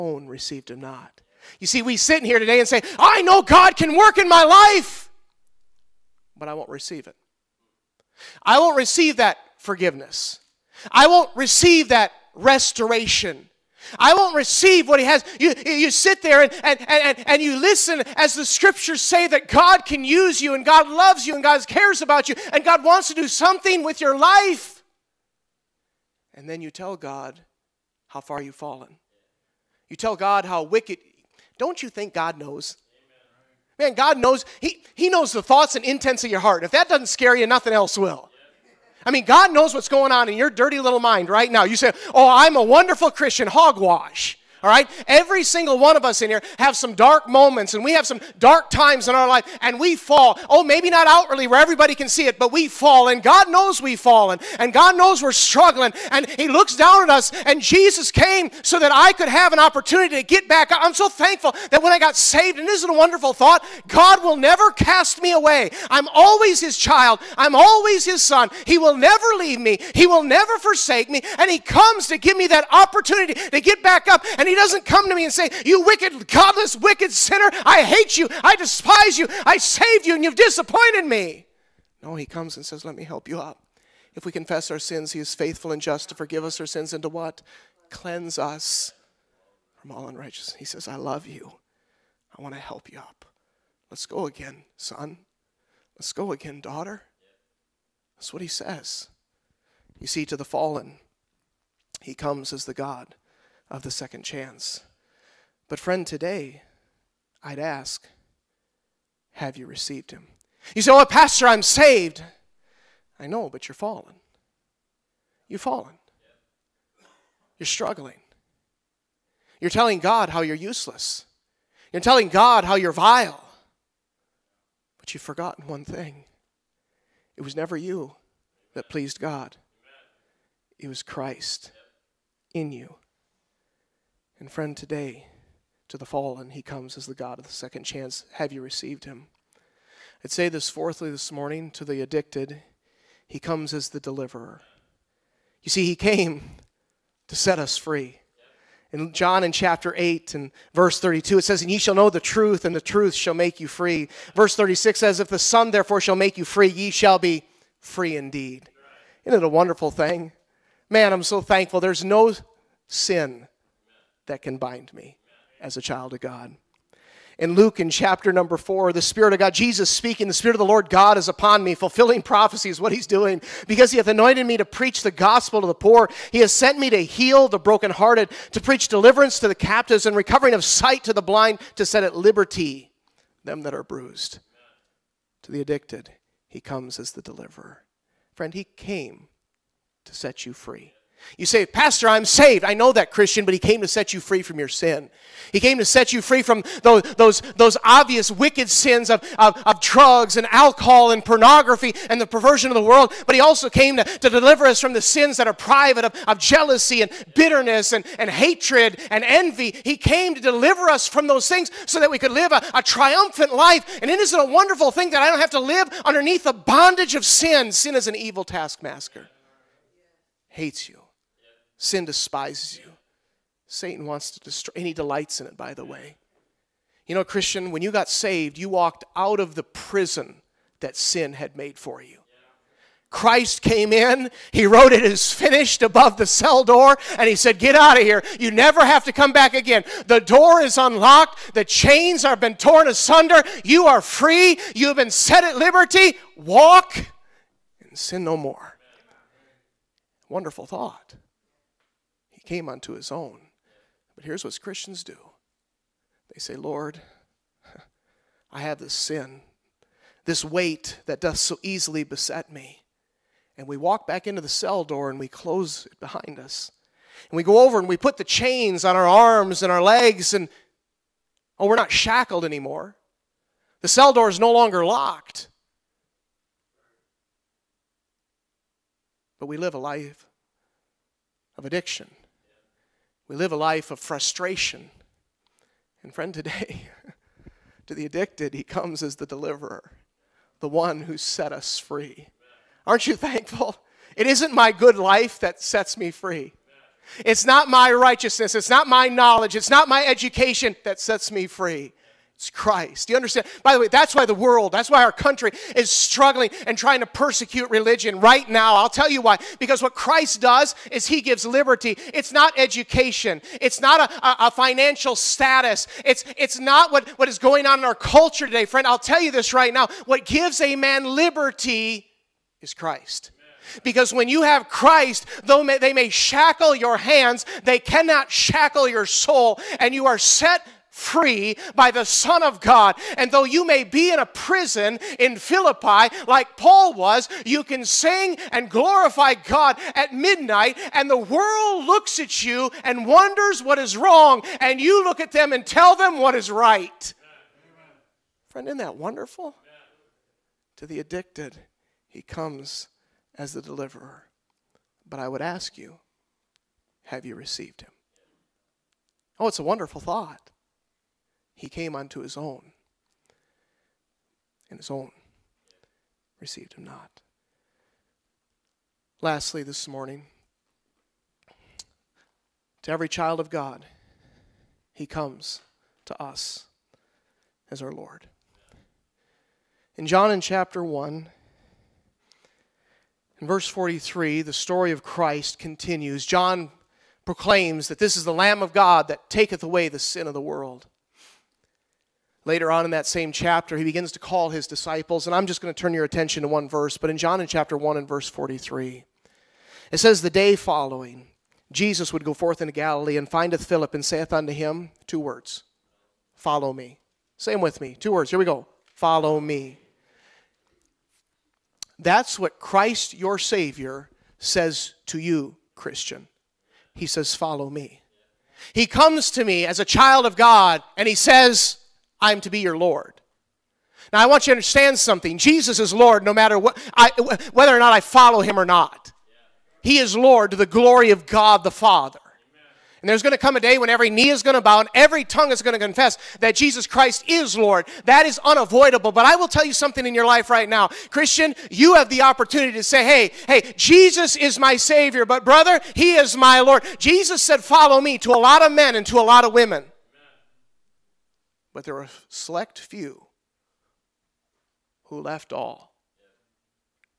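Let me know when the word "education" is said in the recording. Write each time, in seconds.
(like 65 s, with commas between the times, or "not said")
300 s, 312 s.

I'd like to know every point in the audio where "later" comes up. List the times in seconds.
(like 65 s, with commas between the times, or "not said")
392 s.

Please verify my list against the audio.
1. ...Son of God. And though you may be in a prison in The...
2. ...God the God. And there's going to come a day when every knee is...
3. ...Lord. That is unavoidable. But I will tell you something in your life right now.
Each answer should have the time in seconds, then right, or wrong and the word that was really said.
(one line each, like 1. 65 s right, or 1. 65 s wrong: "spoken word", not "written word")
1. 332 s wrong: "Philippi", not "The"
2. 431 s wrong: "Father", not "God"
3. 437 s right.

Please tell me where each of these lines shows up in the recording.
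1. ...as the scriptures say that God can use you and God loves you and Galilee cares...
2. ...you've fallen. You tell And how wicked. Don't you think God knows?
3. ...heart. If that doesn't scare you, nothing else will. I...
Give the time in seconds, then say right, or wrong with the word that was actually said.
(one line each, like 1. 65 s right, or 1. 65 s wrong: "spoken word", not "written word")
1. 18 s wrong: "God", not "Galilee"
2. 28 s wrong: "God", not "And"
3. 36 s right.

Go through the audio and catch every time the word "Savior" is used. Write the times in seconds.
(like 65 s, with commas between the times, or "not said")
413 s, 444 s.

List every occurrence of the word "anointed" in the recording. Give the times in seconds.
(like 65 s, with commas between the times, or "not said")
174 s.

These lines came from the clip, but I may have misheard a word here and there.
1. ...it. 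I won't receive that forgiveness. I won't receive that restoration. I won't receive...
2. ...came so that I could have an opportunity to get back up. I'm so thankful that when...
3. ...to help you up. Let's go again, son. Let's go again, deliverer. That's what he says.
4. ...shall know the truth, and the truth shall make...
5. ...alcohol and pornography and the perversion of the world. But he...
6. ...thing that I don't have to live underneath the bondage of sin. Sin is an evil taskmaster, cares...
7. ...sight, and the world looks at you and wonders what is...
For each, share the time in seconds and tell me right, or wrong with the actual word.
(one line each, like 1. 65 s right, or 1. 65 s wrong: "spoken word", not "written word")
1. 7 s right
2. 58 s right
3. 92 s wrong: "daughter", not "deliverer"
4. 151 s right
5. 200 s right
6. 214 s wrong: "hates", not "cares"
7. 340 s wrong: "midnight", not "sight".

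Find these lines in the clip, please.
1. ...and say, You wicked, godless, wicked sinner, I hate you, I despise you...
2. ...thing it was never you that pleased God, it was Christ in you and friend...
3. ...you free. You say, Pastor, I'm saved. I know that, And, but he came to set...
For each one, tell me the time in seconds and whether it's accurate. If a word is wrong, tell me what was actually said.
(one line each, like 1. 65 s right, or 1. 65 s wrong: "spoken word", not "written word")
1. 75 s right
2. 125 s right
3. 190 s wrong: "Christian", not "And".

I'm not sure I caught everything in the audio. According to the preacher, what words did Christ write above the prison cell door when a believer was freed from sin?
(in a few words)
It is finished.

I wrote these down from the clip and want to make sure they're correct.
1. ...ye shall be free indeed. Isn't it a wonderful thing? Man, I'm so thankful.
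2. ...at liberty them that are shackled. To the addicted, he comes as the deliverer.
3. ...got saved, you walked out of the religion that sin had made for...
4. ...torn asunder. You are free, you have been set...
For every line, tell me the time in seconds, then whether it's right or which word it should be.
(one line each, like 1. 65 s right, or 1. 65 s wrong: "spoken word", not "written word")
1. 156 s right
2. 182 s wrong: "bruised", not "shackled"
3. 227 s wrong: "prison", not "religion"
4. 242 s right.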